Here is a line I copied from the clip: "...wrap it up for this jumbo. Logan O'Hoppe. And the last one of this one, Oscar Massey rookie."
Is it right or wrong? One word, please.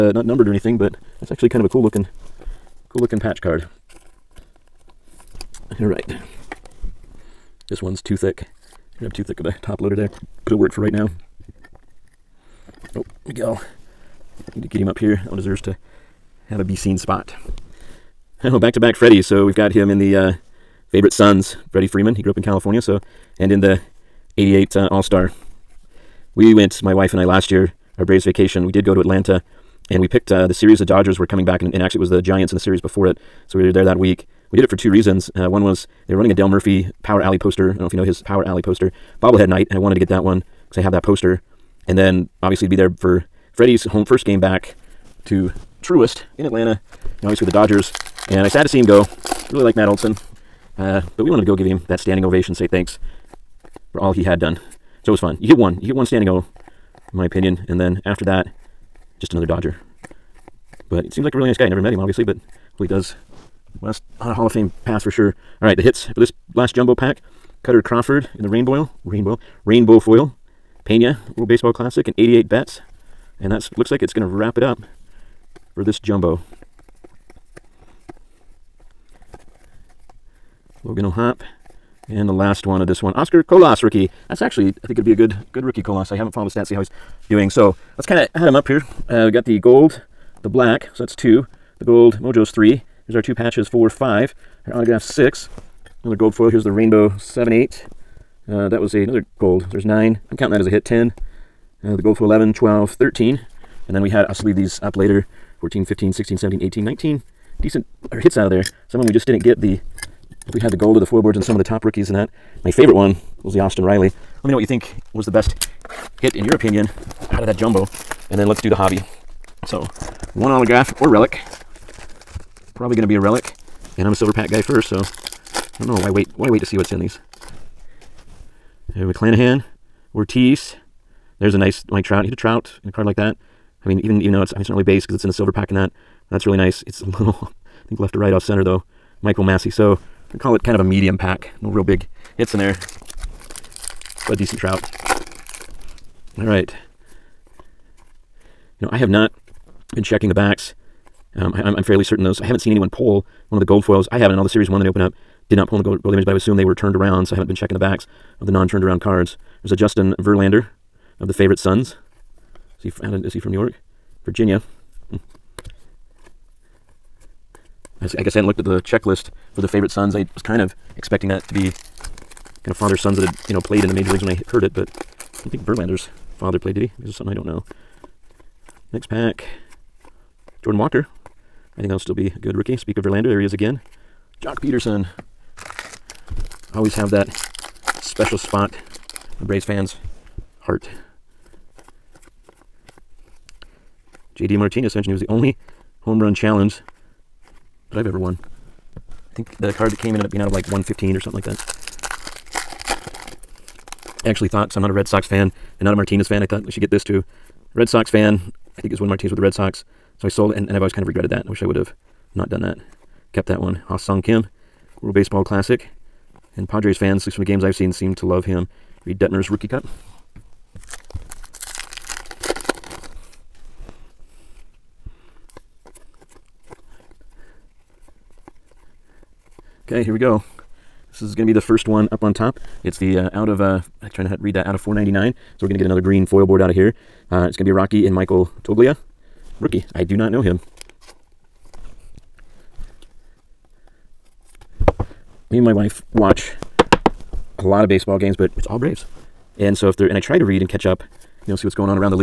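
wrong.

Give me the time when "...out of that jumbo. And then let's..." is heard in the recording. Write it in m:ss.
1:57.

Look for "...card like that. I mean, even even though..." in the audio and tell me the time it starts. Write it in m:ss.
2:12.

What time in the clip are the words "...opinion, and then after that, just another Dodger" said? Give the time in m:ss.
0:57.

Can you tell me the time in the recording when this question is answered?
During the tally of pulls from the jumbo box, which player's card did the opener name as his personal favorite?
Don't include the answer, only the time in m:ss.
1:53.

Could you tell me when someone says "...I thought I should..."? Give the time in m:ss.
3:26.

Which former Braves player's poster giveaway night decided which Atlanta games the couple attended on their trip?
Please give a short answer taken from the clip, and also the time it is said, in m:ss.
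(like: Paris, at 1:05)
Dale Murphy, at 0:36.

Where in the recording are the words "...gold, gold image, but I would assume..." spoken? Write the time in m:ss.
2:35.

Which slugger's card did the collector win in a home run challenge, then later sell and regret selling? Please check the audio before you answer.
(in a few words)
J.D. Martinez.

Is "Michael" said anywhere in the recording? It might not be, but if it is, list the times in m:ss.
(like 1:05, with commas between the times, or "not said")
2:19, 3:58.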